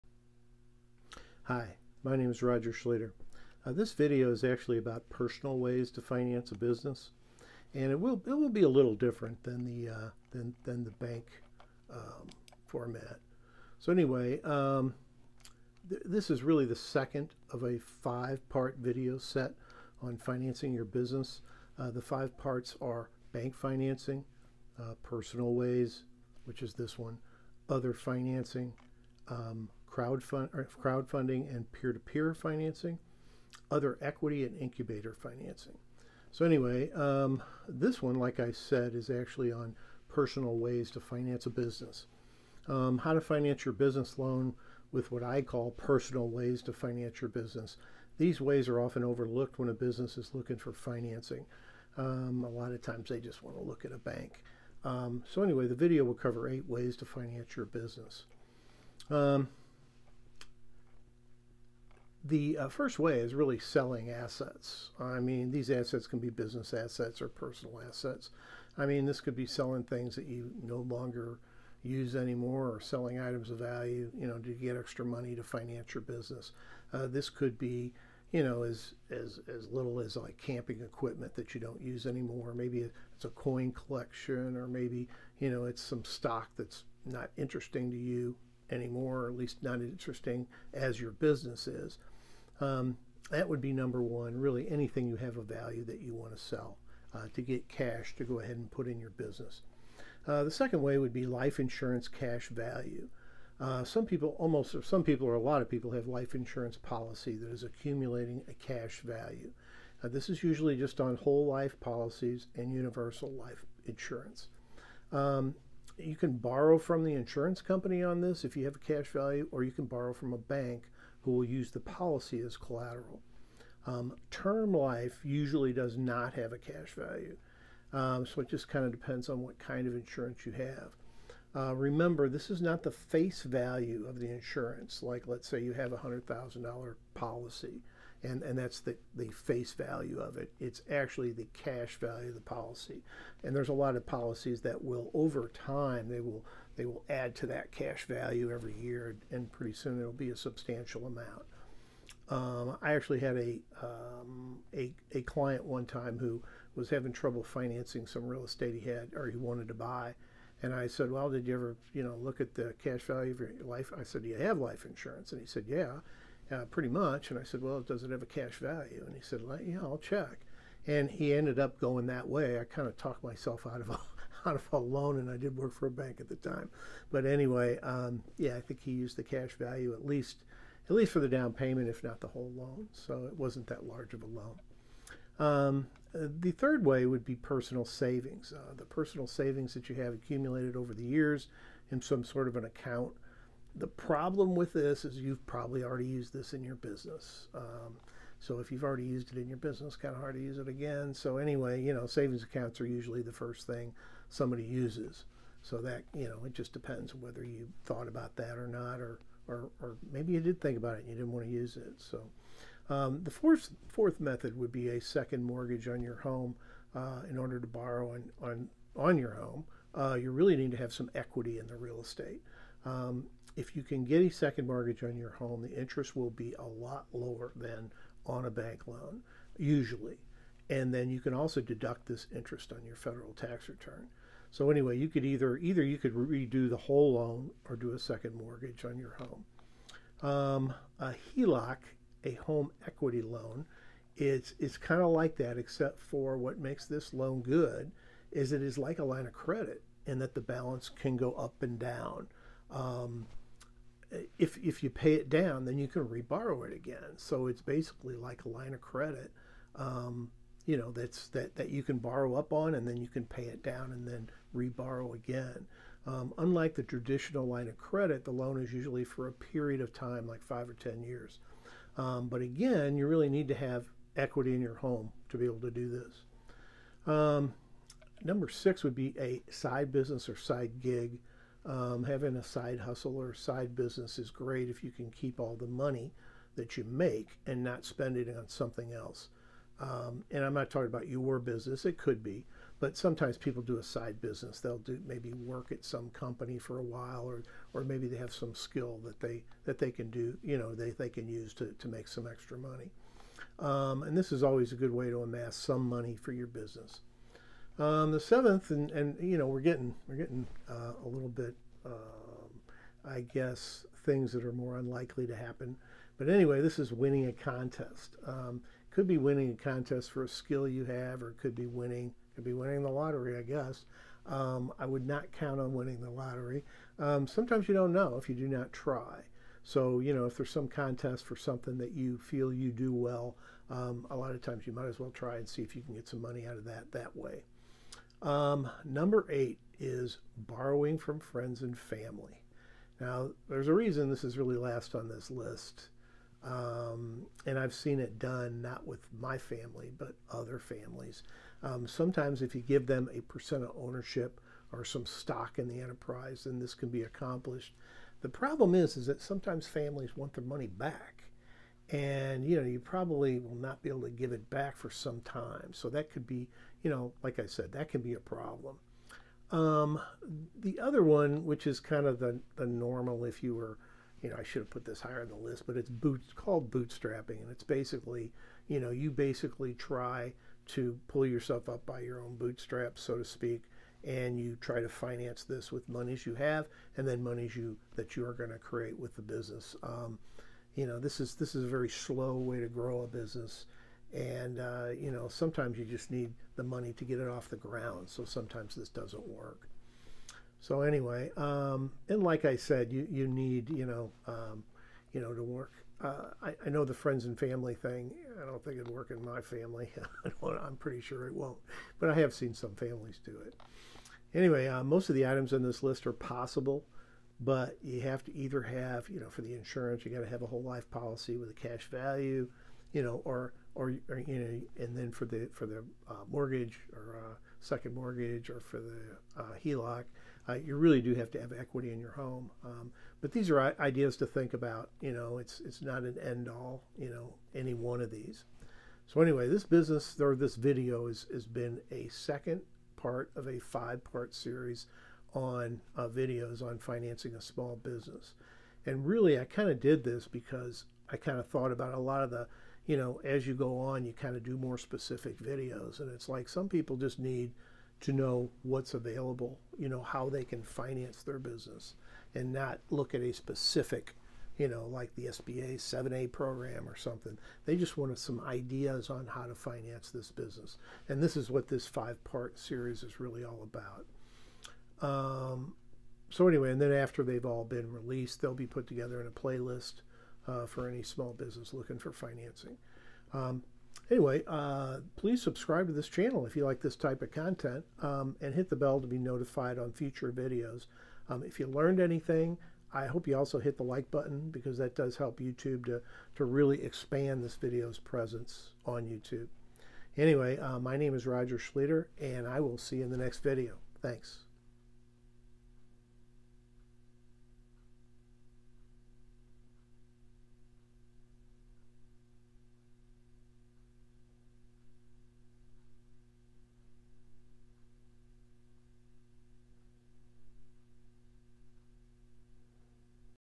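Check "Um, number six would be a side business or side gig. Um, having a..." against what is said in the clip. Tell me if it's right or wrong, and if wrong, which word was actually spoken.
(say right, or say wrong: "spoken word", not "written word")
right.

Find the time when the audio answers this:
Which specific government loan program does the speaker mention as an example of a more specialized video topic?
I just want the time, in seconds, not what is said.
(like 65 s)
465 s.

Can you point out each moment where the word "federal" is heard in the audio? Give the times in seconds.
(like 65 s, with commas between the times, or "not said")
232 s.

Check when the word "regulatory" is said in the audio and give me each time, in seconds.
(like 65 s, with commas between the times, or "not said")
not said.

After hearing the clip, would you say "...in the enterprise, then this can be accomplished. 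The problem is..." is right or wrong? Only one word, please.
right.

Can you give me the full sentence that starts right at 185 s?
Um, uh, the third way would be personal savings.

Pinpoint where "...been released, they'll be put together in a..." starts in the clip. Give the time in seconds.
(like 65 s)
477 s.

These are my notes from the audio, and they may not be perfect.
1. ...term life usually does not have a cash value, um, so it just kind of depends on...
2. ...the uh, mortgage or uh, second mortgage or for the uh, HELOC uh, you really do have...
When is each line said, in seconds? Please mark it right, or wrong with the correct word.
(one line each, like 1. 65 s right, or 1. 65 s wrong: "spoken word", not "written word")
1. 124 s right
2. 425 s right.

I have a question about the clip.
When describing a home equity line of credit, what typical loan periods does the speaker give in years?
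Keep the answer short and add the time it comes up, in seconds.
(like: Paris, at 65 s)
5 or 10 years, at 270 s.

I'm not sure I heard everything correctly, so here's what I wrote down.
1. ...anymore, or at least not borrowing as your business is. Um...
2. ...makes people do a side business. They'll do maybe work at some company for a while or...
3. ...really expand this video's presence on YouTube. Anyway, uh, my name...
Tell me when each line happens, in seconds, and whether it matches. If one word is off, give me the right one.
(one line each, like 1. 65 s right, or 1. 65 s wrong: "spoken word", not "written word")
1. 88 s wrong: "interesting", not "borrowing"
2. 292 s wrong: "sometimes", not "makes"
3. 496 s right.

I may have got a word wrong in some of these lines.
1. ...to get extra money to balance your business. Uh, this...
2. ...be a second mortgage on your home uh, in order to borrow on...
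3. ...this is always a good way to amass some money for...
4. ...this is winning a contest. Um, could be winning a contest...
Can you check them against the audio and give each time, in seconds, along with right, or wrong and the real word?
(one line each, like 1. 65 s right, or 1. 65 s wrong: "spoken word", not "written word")
1. 74 s wrong: "finance", not "balance"
2. 214 s right
3. 304 s right
4. 316 s right.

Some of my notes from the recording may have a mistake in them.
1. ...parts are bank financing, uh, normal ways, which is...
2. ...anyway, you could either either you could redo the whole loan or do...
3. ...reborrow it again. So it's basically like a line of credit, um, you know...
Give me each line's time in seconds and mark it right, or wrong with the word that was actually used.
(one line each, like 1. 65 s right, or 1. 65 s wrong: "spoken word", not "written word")
1. 22 s wrong: "personal", not "normal"
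2. 234 s right
3. 256 s right.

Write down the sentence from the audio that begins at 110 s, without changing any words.
Uh, this is usually just on whole life policies and universal life insurance.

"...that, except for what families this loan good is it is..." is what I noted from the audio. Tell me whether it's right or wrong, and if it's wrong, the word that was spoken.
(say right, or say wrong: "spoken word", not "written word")
wrong: "makes", not "families".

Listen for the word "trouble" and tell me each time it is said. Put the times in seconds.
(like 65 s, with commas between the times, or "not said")
157 s.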